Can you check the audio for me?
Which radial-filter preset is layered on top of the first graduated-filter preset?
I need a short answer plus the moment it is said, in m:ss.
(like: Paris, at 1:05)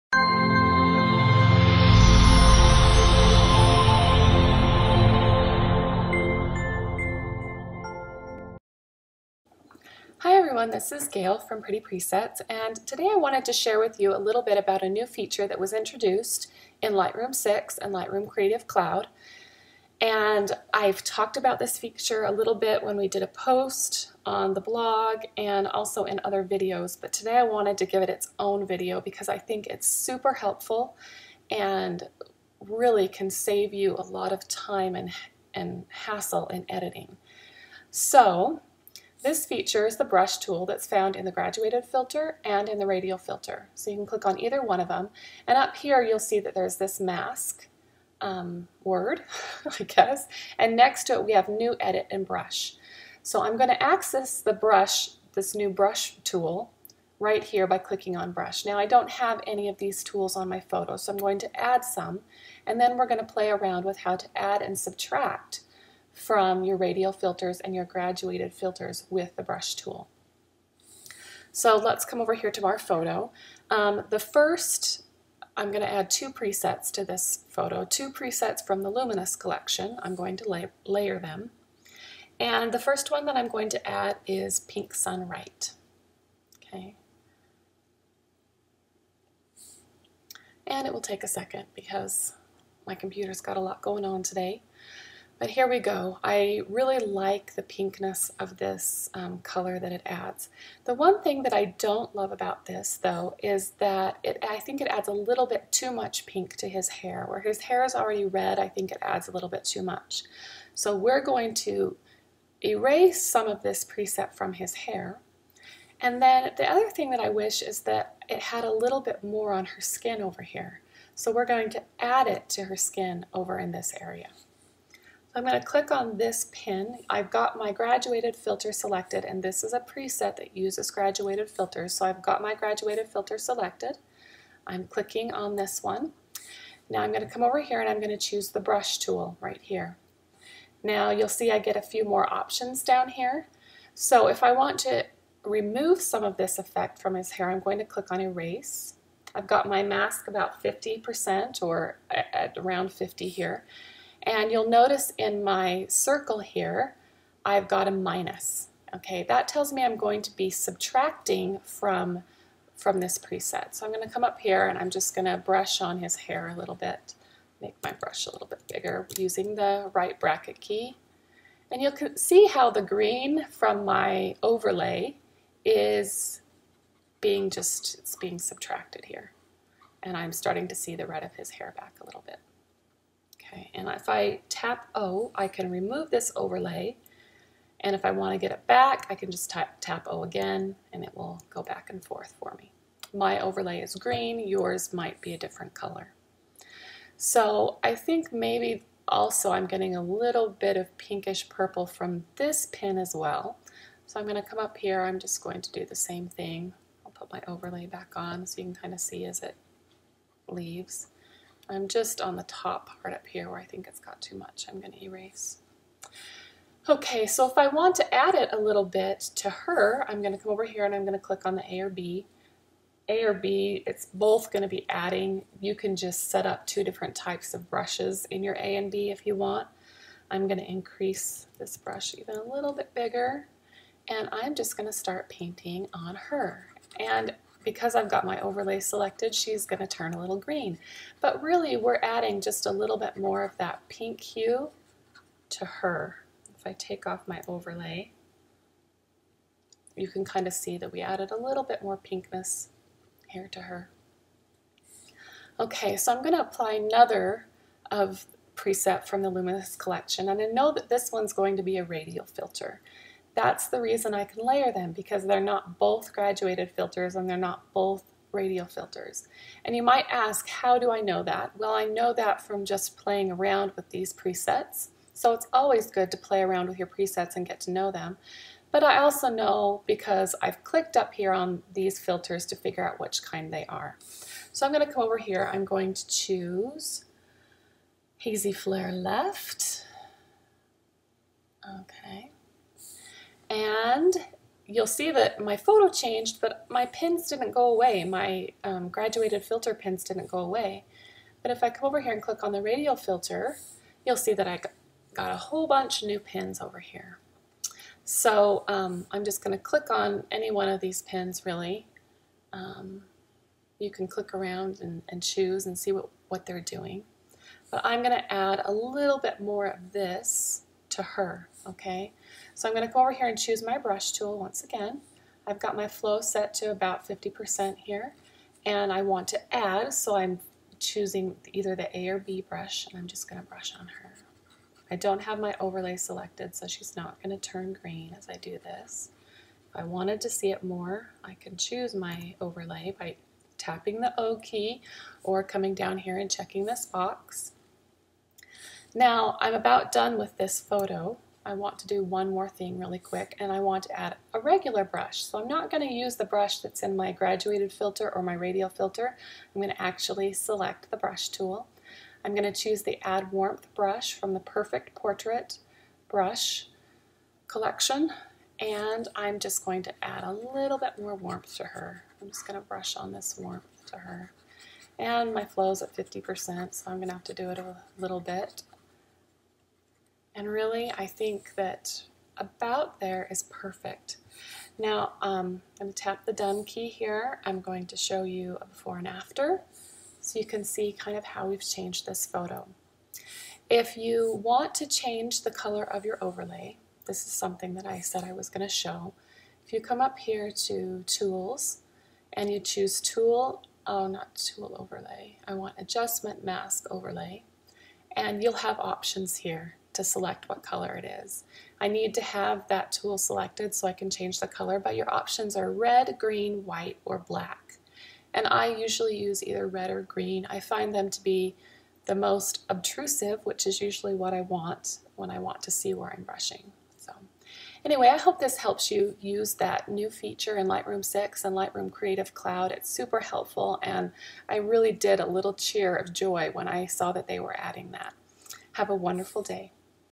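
Hazy Flare Left, at 4:48.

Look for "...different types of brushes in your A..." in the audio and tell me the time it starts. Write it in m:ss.
3:46.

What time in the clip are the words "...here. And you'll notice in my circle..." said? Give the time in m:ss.
2:33.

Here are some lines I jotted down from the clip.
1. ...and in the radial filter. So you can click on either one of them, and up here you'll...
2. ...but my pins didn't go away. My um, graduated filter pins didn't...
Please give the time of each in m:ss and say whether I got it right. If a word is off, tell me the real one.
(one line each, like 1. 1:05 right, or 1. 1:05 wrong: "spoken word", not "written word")
1. 0:42 right
2. 4:56 right.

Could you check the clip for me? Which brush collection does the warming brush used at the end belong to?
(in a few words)
Perfect Portrait.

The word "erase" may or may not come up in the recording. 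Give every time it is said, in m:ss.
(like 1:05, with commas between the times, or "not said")
1:52, 2:28, 3:35.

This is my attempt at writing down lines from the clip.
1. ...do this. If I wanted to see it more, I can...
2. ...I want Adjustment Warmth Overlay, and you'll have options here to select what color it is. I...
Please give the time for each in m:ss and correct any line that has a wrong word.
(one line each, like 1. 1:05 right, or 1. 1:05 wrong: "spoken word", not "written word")
1. 5:38 right
2. 6:45 wrong: "Mask", not "Warmth".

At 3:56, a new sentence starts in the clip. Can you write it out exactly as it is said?
And because I've got my overlay selected, she's going to turn a little green.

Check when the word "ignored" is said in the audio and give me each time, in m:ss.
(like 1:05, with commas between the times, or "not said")
not said.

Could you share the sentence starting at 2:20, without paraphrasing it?
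Now you'll see I get a few more options down here.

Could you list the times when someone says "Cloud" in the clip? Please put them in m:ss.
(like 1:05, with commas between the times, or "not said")
0:18, 7:12.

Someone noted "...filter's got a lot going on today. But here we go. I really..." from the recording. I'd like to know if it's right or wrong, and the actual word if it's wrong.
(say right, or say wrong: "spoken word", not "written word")
wrong: "computer", not "filter".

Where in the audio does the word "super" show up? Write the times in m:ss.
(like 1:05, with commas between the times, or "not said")
0:29, 7:12.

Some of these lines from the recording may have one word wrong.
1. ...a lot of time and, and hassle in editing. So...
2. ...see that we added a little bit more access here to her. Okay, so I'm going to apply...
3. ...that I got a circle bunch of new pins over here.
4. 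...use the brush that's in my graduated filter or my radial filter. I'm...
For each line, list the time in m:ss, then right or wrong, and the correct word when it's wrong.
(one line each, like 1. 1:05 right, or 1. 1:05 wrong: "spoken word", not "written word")
1. 0:33 right
2. 4:10 wrong: "pinkness", not "access"
3. 5:04 wrong: "whole", not "circle"
4. 5:55 right.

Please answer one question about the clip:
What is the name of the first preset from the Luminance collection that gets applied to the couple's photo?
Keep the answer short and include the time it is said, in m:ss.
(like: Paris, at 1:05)
Pink Sun Right, at 1:24.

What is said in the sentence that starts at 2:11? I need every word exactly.
So I've got my graduated filter selected.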